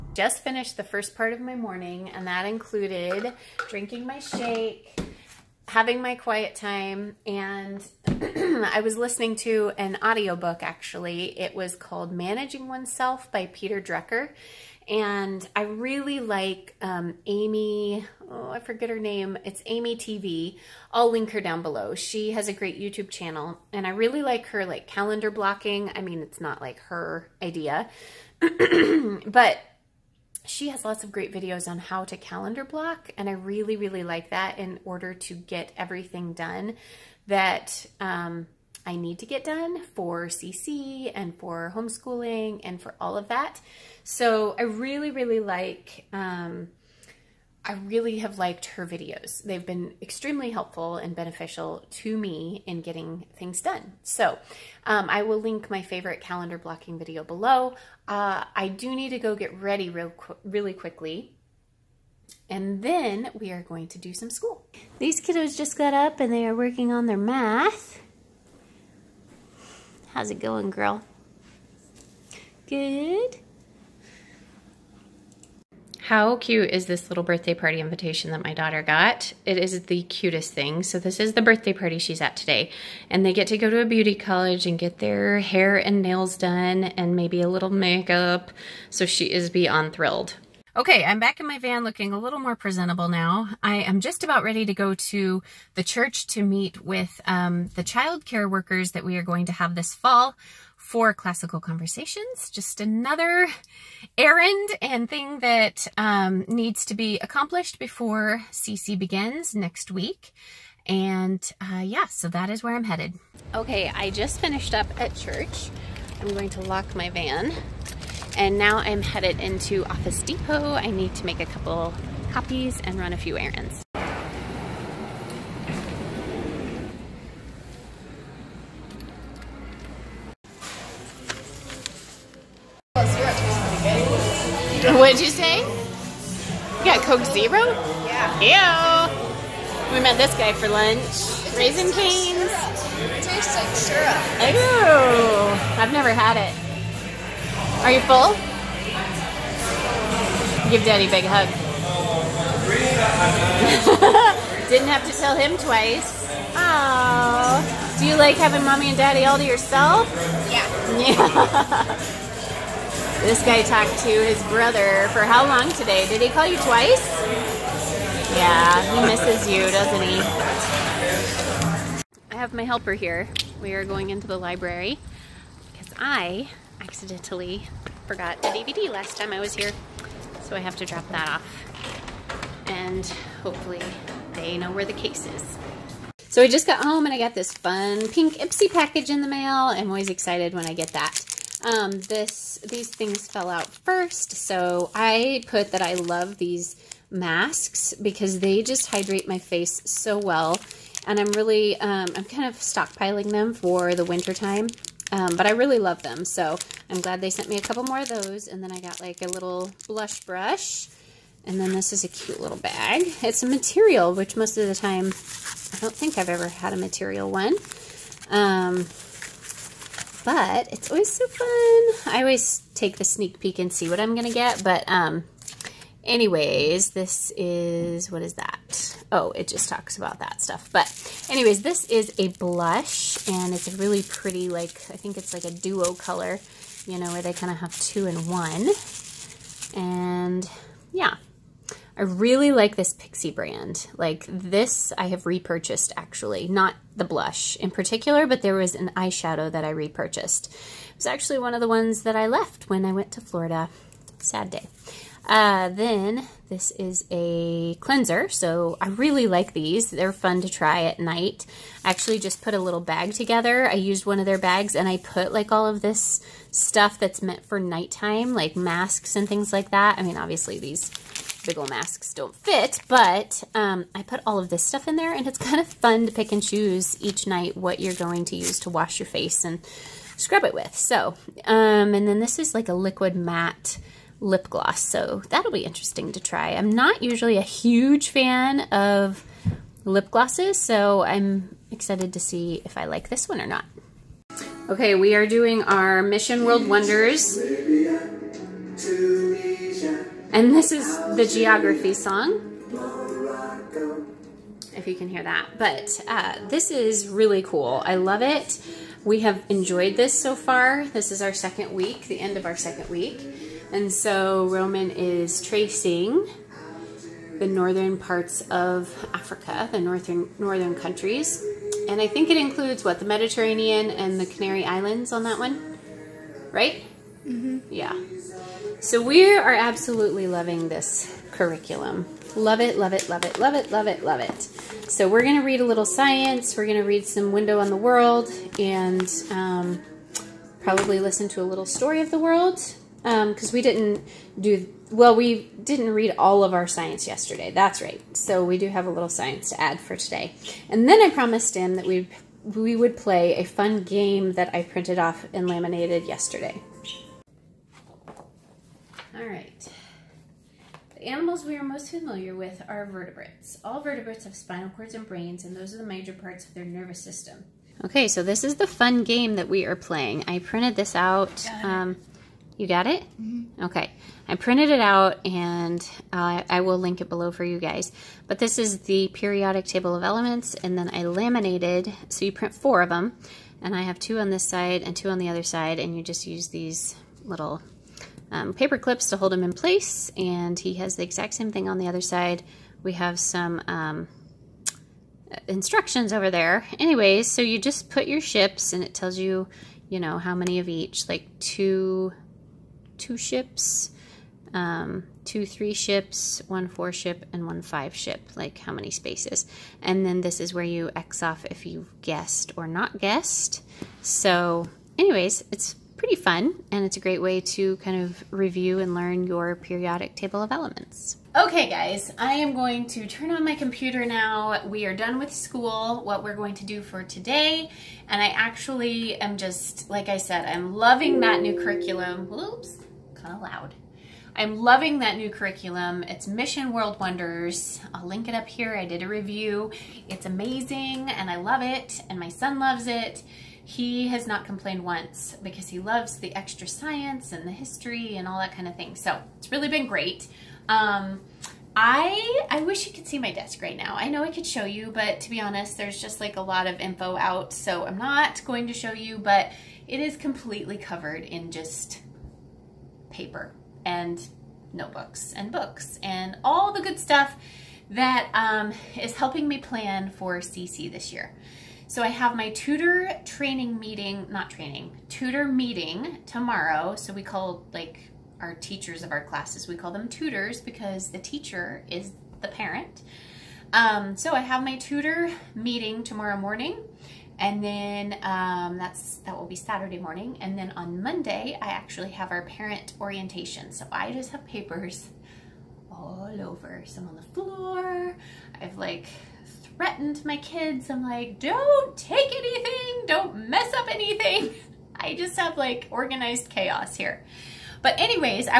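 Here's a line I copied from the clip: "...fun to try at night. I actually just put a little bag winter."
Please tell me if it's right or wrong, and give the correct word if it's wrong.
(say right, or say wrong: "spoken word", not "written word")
wrong: "together", not "winter".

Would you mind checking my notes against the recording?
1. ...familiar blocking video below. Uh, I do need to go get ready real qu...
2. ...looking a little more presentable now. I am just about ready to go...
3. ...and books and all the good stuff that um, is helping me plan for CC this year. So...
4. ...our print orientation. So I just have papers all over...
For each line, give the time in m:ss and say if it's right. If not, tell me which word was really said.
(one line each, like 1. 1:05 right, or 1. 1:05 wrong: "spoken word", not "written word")
1. 0:56 wrong: "calendar", not "familiar"
2. 1:31 right
3. 7:45 right
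4. 8:12 wrong: "parent", not "print".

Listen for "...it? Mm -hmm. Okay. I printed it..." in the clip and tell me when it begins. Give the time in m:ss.
6:12.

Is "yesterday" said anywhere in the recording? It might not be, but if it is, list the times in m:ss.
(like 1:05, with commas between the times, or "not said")
5:47, 5:56.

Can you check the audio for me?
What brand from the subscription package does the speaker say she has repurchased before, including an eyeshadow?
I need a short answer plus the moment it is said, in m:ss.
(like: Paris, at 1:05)
Pixi, at 4:02.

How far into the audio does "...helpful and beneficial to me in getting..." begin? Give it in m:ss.
0:50.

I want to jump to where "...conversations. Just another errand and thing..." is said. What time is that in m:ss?
1:41.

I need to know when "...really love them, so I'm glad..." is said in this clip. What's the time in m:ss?
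3:25.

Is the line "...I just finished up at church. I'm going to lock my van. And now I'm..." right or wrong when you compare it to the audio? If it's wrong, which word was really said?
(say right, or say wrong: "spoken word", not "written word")
right.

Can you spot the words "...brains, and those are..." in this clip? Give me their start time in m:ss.
6:05.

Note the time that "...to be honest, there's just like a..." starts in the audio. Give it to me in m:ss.
7:35.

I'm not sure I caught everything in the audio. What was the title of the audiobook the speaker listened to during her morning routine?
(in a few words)
Managing Oneself.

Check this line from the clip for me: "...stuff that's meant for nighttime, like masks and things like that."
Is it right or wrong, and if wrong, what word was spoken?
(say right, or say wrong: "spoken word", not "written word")
right.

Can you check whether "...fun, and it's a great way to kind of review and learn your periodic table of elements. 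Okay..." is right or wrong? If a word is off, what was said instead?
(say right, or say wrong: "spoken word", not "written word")
right.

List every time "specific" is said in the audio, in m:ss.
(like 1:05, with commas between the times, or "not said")
not said.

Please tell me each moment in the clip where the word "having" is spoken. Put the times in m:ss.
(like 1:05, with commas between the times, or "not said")
0:05, 2:38.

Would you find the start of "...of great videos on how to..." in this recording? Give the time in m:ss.
0:31.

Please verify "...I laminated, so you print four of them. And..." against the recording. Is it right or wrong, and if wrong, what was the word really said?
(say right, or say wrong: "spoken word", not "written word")
right.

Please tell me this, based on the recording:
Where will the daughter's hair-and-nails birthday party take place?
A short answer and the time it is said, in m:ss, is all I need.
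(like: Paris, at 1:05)
a beauty college, at 1:23.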